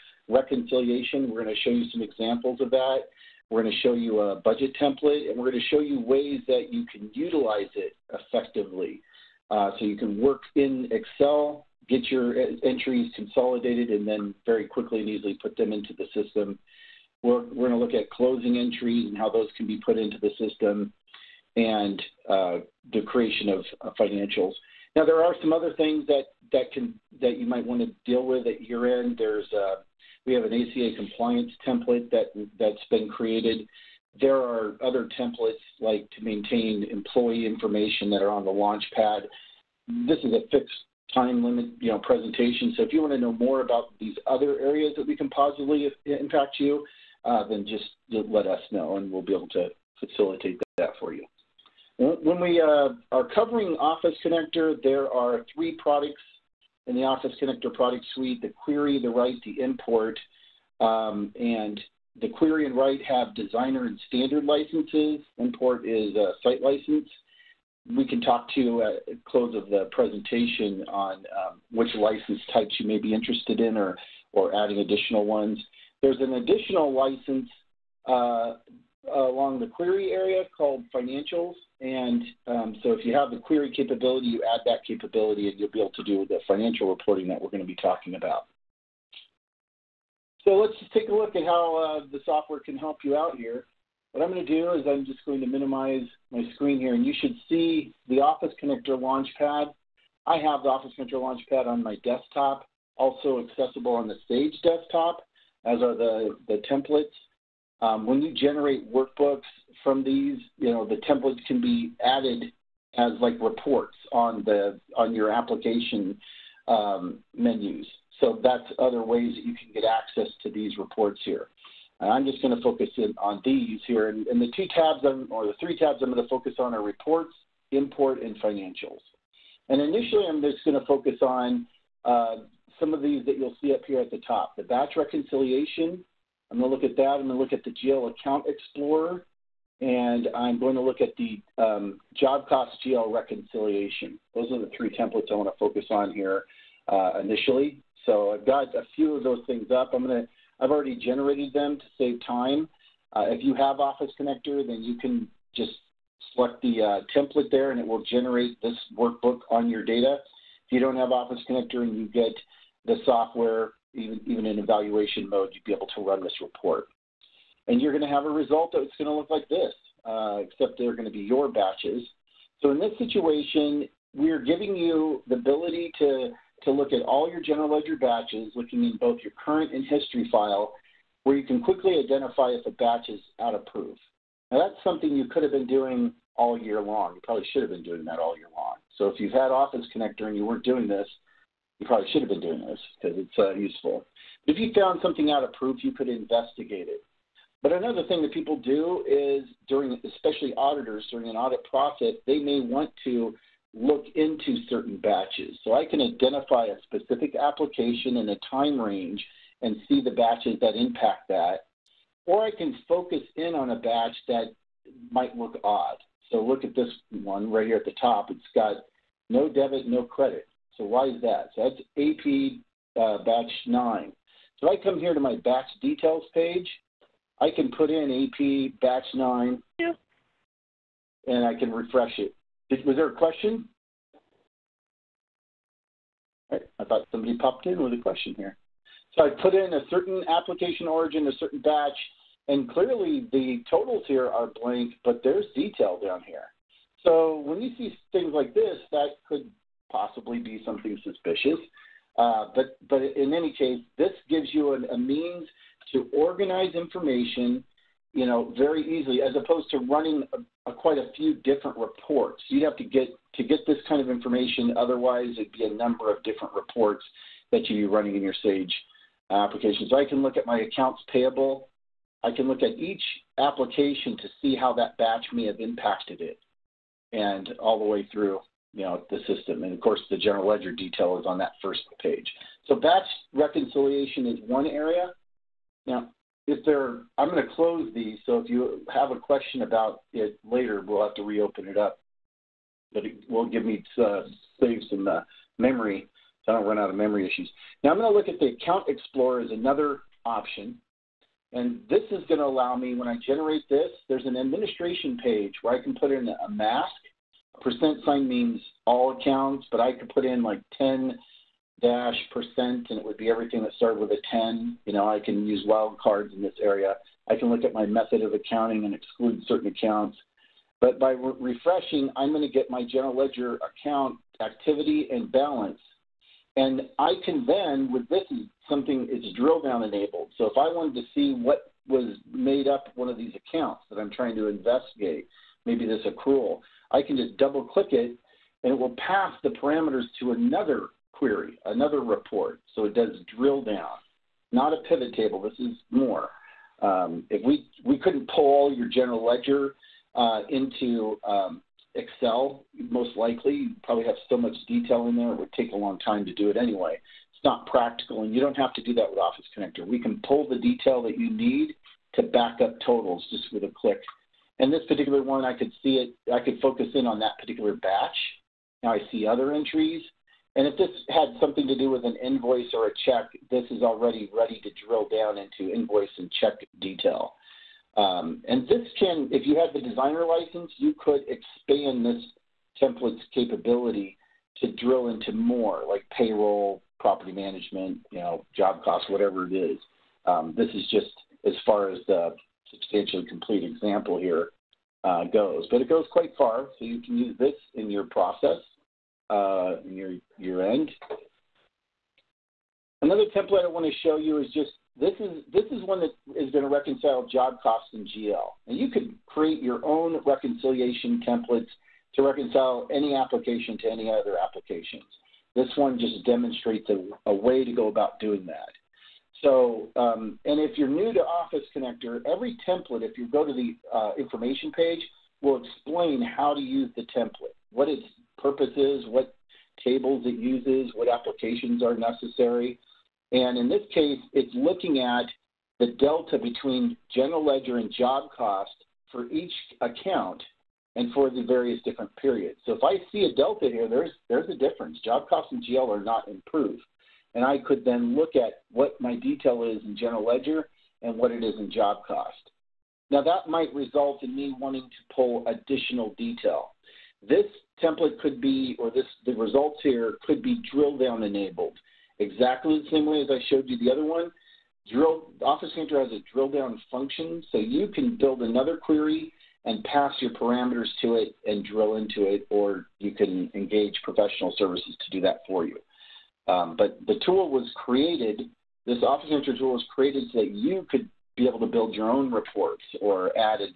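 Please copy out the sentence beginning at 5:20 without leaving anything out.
But by re- refreshing, I'm going to get my general ledger account activity and balance.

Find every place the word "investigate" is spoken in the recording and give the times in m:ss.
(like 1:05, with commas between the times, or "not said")
3:16, 5:34.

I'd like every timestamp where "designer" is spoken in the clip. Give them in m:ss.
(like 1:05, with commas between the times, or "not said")
1:03, 6:19.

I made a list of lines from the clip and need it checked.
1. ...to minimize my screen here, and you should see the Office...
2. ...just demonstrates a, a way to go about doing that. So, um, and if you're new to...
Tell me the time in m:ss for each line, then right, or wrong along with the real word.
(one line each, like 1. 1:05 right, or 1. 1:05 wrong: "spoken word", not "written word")
1. 1:35 right
2. 6:55 right.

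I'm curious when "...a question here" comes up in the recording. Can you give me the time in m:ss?
3:57.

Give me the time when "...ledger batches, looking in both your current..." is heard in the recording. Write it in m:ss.
2:57.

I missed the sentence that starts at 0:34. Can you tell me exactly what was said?
There are other templates like to maintain employee information that are on the launch pad.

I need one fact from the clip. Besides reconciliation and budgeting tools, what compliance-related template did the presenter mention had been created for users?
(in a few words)
ACA compliance template.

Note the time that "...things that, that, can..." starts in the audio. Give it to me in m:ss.
0:25.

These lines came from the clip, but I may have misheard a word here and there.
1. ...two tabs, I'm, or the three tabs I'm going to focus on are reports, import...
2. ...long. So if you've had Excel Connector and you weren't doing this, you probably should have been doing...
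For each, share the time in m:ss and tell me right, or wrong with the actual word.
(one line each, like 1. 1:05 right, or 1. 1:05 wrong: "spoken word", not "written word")
1. 2:04 right
2. 3:08 wrong: "Office", not "Excel".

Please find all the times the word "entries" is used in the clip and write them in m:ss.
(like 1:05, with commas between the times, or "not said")
0:12, 0:18, 6:09.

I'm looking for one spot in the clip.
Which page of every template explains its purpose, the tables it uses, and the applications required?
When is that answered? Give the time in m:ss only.
7:04.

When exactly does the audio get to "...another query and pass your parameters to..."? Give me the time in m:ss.
7:48.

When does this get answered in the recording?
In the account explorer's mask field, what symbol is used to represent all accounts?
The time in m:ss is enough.
5:07.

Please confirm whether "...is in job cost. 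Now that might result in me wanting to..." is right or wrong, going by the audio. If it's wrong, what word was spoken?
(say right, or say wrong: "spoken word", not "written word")
right.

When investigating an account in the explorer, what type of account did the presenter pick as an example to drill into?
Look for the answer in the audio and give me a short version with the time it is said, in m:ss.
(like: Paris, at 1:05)
accrual, at 5:36.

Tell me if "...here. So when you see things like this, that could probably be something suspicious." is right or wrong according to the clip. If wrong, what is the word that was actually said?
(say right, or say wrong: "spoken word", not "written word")
wrong: "possibly", not "probably".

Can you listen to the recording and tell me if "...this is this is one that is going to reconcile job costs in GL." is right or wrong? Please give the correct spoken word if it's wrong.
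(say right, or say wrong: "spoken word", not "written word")
right.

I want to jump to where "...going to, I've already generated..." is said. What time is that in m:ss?
2:30.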